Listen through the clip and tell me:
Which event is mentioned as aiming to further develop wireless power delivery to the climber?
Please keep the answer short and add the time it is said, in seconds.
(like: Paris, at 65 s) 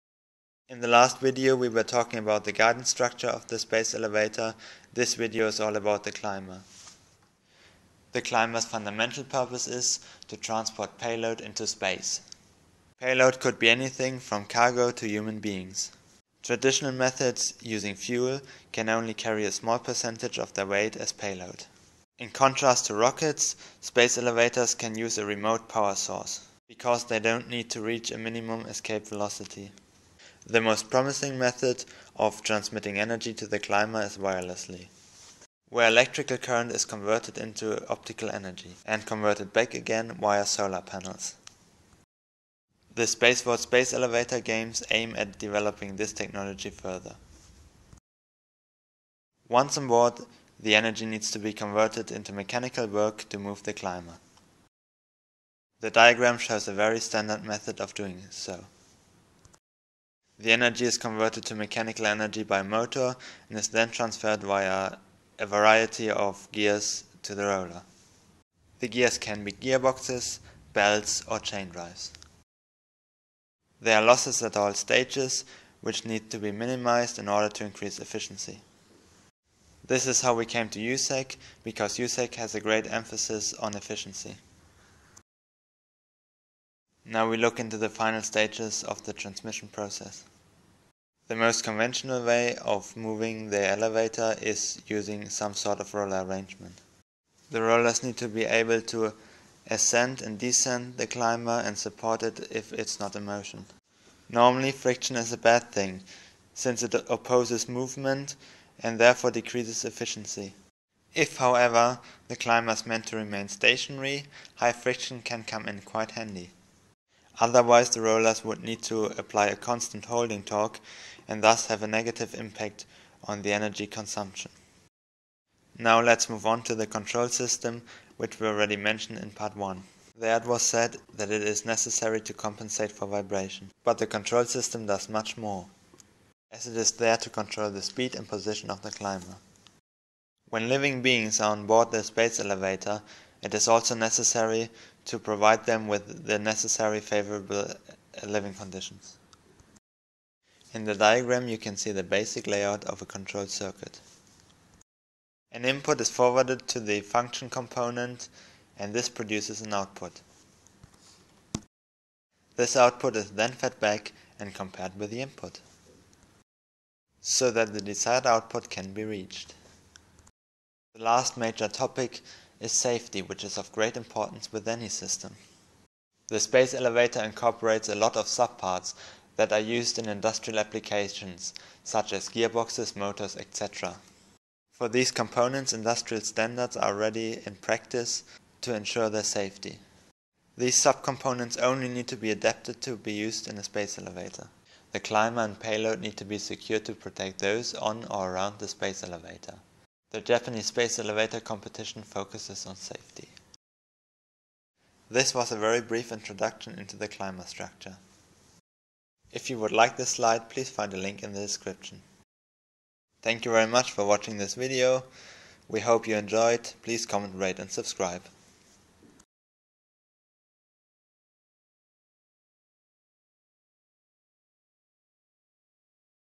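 World Space Elevator games, at 43 s.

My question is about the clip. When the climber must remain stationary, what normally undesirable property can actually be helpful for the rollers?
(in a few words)
High friction.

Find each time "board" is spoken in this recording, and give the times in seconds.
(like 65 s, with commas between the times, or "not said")
49 s, 141 s.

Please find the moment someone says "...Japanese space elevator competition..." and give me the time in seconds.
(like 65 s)
200 s.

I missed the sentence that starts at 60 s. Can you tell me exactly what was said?
The energy is converted to mechanical energy by motor and is then transferred via a variety of gears to the roller.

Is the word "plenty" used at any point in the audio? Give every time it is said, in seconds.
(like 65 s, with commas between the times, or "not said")
not said.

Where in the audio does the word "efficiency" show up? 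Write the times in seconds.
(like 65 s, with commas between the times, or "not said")
77 s, 83 s, 109 s.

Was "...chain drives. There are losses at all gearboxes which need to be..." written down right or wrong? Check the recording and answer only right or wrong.
wrong.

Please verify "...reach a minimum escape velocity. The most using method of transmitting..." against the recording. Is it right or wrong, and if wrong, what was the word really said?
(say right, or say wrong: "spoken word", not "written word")
wrong: "promising", not "using".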